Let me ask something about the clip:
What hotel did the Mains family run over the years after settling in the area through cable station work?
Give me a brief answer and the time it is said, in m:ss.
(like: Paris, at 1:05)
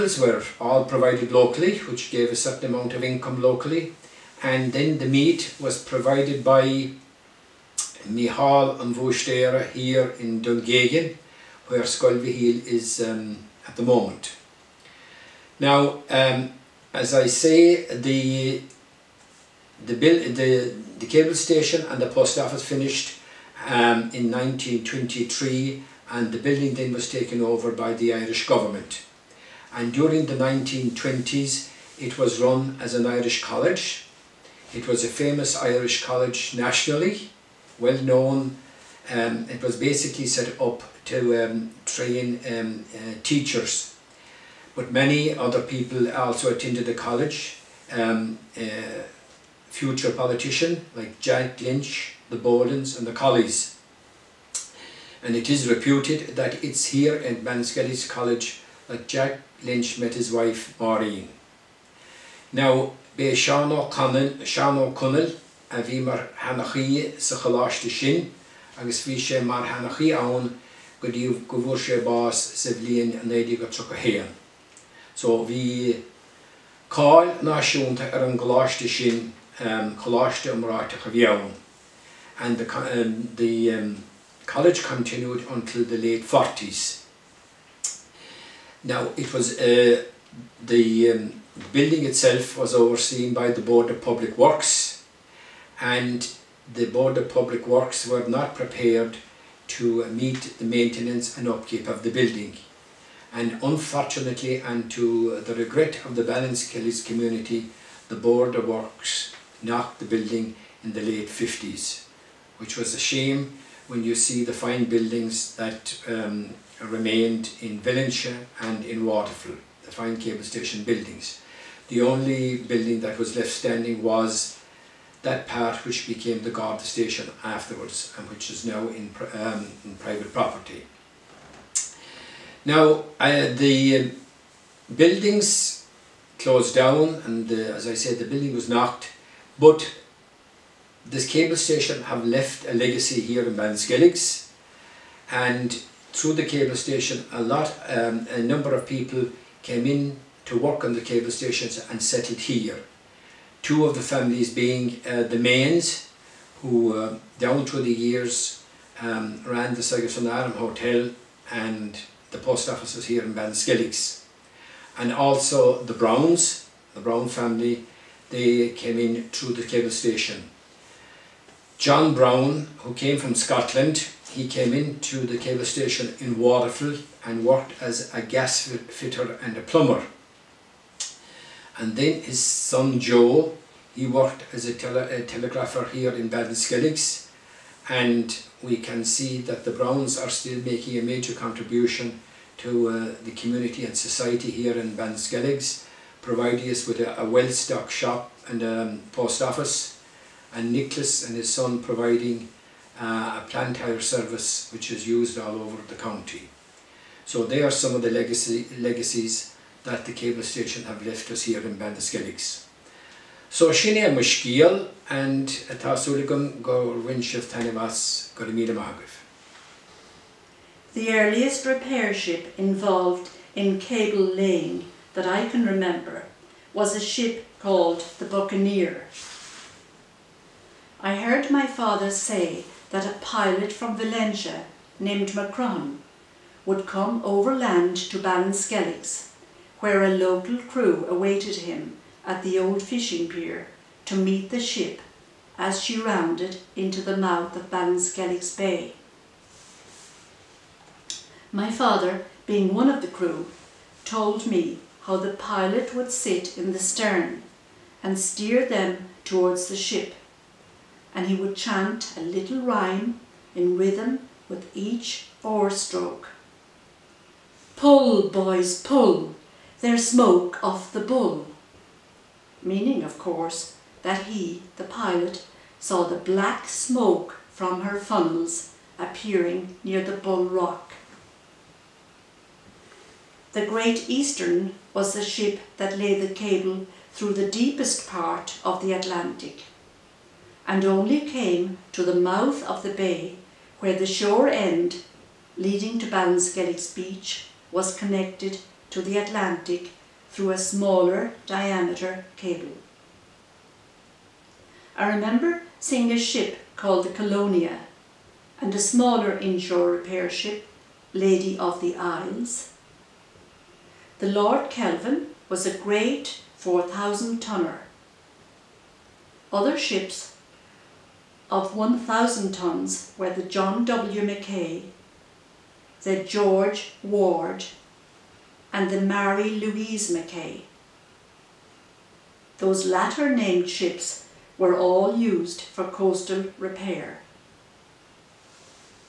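Sagerson Hotel, at 2:39.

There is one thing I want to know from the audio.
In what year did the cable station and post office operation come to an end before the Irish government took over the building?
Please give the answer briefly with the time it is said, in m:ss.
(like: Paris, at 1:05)
1923, at 0:24.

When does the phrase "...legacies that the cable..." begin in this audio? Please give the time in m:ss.
3:28.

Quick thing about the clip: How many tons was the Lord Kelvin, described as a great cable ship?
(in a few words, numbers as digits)
4,000.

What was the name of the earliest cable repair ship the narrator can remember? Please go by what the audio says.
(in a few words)
Buccaneer.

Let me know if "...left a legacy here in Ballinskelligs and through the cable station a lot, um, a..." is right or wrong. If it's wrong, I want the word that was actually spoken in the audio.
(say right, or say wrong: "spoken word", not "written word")
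right.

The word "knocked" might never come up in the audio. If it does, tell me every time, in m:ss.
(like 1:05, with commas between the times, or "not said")
1:49, 2:18.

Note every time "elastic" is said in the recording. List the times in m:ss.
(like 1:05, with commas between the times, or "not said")
not said.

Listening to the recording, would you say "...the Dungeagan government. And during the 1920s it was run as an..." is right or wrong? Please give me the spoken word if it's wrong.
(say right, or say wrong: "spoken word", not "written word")
wrong: "Irish", not "Dungeagan".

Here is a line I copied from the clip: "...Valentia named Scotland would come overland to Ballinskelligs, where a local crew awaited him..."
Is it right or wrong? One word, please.
wrong.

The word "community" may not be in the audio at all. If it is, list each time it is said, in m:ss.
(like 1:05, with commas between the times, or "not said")
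1:47, 3:13.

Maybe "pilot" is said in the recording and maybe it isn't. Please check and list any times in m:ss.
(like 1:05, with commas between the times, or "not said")
3:53, 4:15, 4:34.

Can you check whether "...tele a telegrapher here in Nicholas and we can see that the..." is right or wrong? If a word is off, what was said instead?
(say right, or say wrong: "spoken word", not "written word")
wrong: "Ballinskelligs", not "Nicholas".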